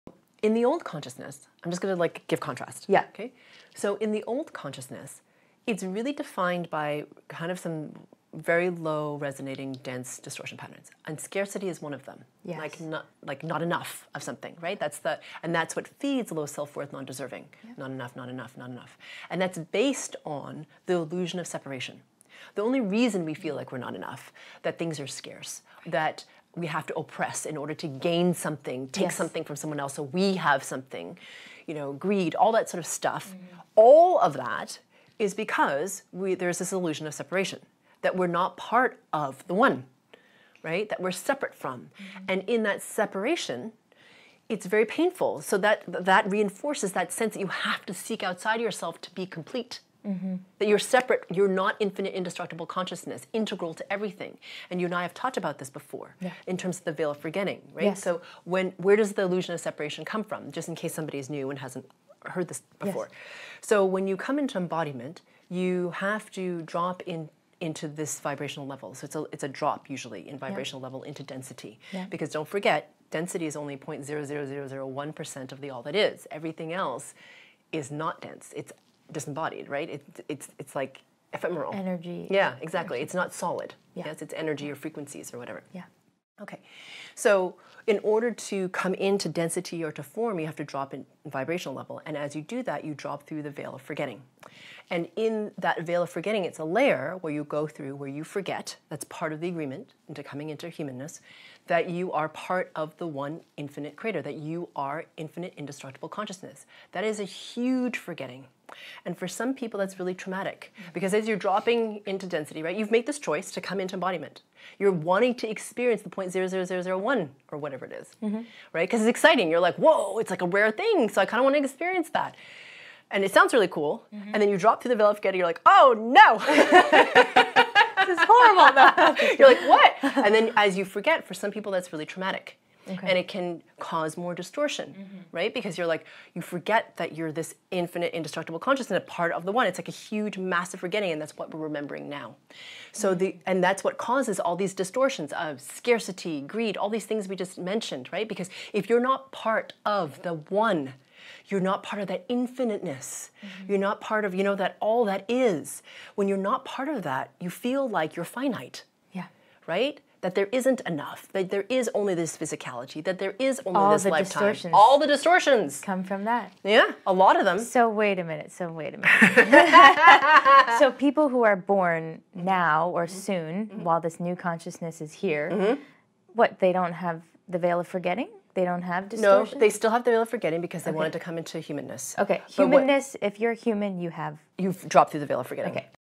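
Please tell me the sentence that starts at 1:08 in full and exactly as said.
So it's a it's a drop usually in vibrational yeah.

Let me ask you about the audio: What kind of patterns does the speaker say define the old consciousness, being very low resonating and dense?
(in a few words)
distortion patterns.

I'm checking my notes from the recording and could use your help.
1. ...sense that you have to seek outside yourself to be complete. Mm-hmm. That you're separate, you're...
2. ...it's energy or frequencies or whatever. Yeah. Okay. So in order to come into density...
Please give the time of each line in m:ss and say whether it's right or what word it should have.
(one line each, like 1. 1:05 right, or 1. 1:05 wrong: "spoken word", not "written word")
1. 0:47 right
2. 1:24 right.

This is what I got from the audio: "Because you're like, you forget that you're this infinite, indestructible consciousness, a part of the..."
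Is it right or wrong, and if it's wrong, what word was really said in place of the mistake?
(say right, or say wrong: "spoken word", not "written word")
right.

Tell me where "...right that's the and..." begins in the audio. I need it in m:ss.
0:14.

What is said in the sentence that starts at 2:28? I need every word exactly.
Because if you're not part of the one, you're not part of that infiniteness.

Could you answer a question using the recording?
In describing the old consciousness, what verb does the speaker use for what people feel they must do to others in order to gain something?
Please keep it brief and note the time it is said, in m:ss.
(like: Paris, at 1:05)
oppress, at 0:26.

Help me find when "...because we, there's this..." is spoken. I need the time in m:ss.
0:35.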